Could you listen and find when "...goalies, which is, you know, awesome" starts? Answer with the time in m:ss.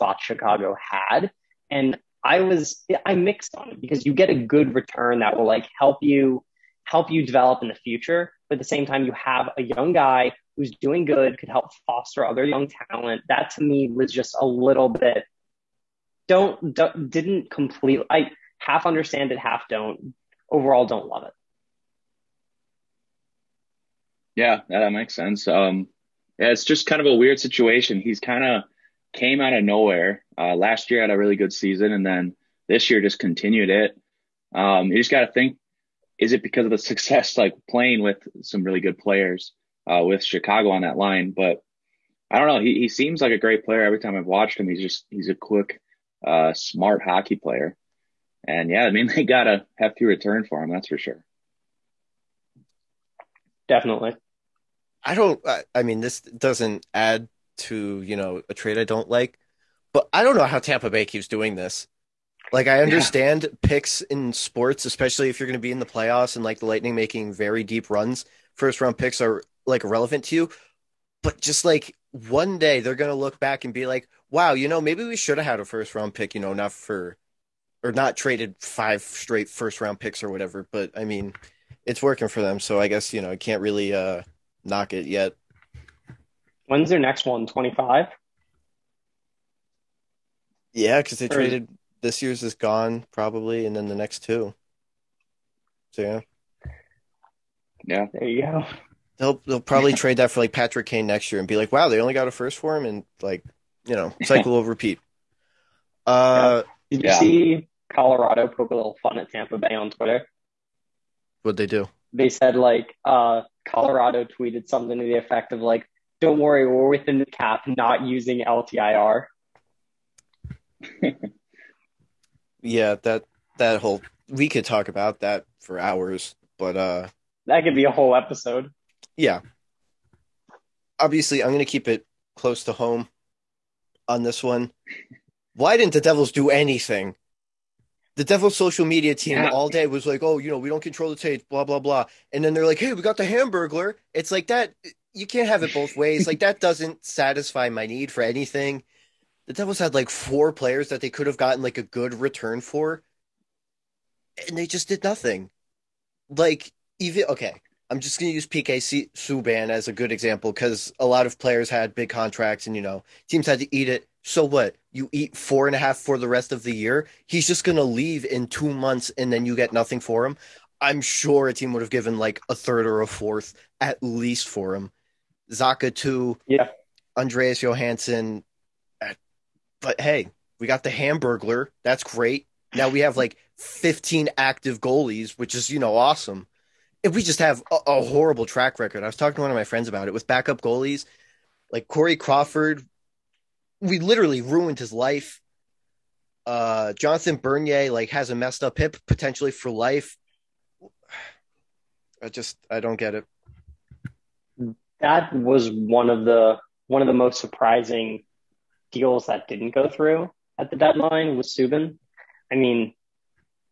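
3:04.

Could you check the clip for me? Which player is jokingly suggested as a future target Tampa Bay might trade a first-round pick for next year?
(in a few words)
Patrick Kane.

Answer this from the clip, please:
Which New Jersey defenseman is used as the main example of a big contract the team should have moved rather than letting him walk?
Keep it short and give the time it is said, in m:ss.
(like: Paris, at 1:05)
PK Subban, at 2:38.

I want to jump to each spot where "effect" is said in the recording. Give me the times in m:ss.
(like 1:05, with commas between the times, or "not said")
1:55.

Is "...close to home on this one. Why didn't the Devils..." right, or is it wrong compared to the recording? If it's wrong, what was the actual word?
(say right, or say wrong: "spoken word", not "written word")
right.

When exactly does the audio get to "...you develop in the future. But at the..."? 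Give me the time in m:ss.
0:07.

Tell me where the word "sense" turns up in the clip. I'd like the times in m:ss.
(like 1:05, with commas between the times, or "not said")
0:25.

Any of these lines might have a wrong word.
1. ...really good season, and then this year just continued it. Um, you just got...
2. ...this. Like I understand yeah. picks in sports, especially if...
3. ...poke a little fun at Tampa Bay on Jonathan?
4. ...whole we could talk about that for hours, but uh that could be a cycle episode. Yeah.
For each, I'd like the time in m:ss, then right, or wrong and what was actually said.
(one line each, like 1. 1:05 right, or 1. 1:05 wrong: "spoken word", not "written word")
1. 0:31 right
2. 1:01 right
3. 1:48 wrong: "Twitter", not "Jonathan"
4. 2:03 wrong: "whole", not "cycle".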